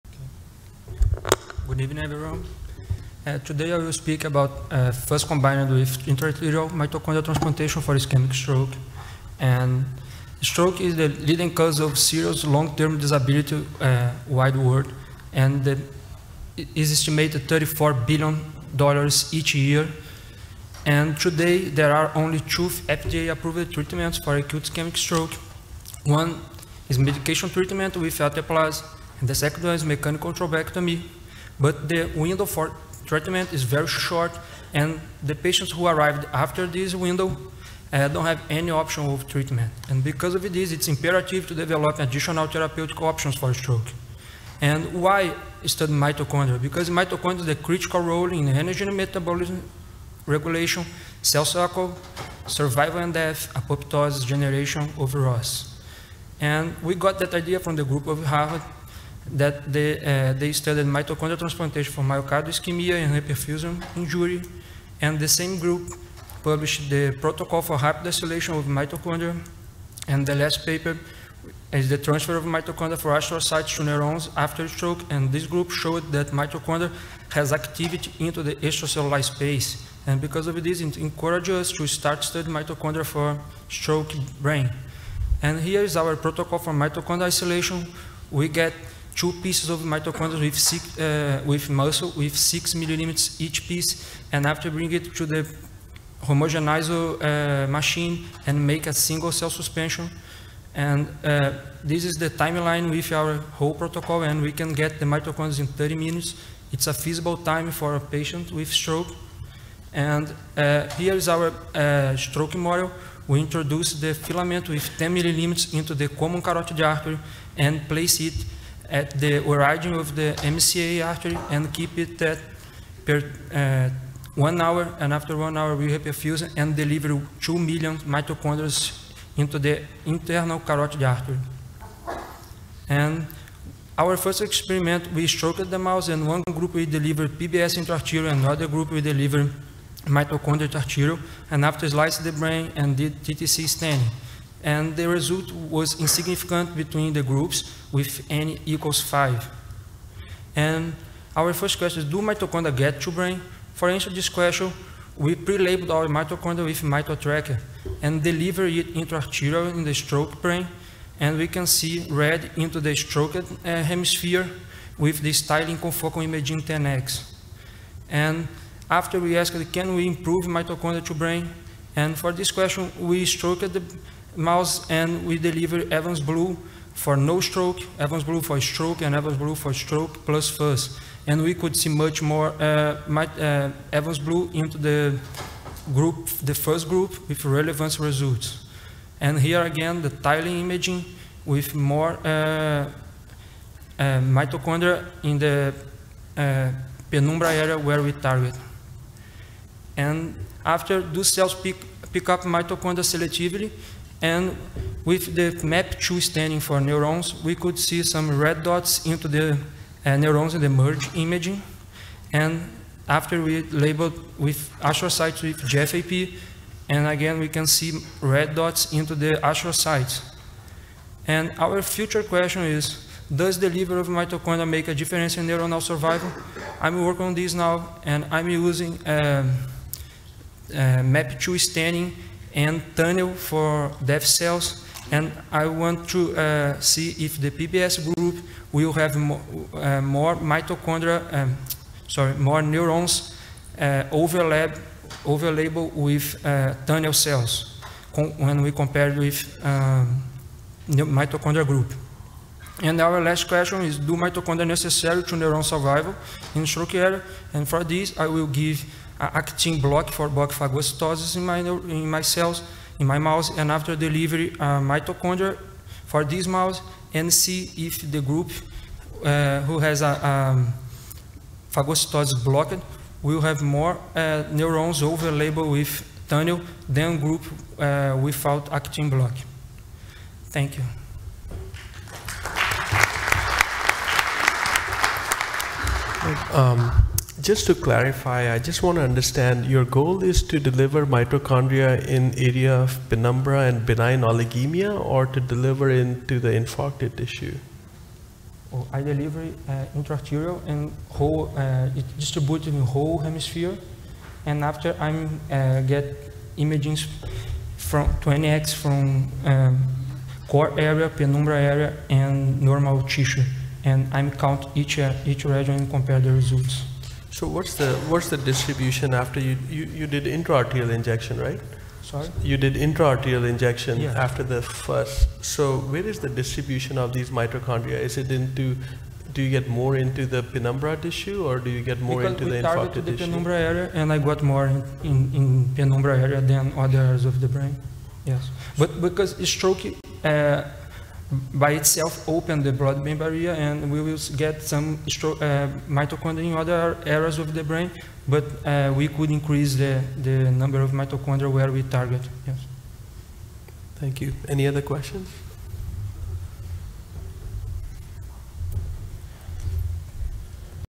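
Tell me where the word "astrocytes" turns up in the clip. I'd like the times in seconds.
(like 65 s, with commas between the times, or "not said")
73 s, 214 s, 219 s.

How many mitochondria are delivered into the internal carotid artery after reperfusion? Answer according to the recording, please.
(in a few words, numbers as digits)
2 million.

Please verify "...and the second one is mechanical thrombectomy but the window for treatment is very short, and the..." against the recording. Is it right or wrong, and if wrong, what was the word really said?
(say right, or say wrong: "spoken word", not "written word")
right.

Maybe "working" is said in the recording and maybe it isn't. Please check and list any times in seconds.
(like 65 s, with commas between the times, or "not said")
227 s.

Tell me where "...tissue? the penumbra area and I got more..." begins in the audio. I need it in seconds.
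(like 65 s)
333 s.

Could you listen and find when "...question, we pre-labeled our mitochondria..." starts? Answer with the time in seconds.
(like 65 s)
154 s.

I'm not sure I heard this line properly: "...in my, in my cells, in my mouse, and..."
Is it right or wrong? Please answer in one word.
right.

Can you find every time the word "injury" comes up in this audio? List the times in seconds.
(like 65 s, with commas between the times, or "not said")
63 s.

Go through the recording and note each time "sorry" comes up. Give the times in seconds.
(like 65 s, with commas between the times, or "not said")
242 s, 322 s.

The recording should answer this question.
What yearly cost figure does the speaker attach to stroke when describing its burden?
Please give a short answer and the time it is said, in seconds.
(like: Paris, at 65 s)
34 billion dollars, at 17 s.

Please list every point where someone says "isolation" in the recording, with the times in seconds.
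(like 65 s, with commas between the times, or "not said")
68 s, 87 s.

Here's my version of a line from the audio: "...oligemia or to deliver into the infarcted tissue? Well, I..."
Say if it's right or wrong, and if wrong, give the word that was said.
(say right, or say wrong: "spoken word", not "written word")
right.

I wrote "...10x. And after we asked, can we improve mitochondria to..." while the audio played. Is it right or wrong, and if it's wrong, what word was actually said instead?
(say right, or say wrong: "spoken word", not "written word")
right.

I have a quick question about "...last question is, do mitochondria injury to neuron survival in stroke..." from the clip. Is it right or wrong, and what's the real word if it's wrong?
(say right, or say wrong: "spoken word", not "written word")
wrong: "necessary", not "injury".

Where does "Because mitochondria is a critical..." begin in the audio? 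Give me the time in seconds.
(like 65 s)
46 s.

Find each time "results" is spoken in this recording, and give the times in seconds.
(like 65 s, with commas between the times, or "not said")
145 s, 187 s, 316 s.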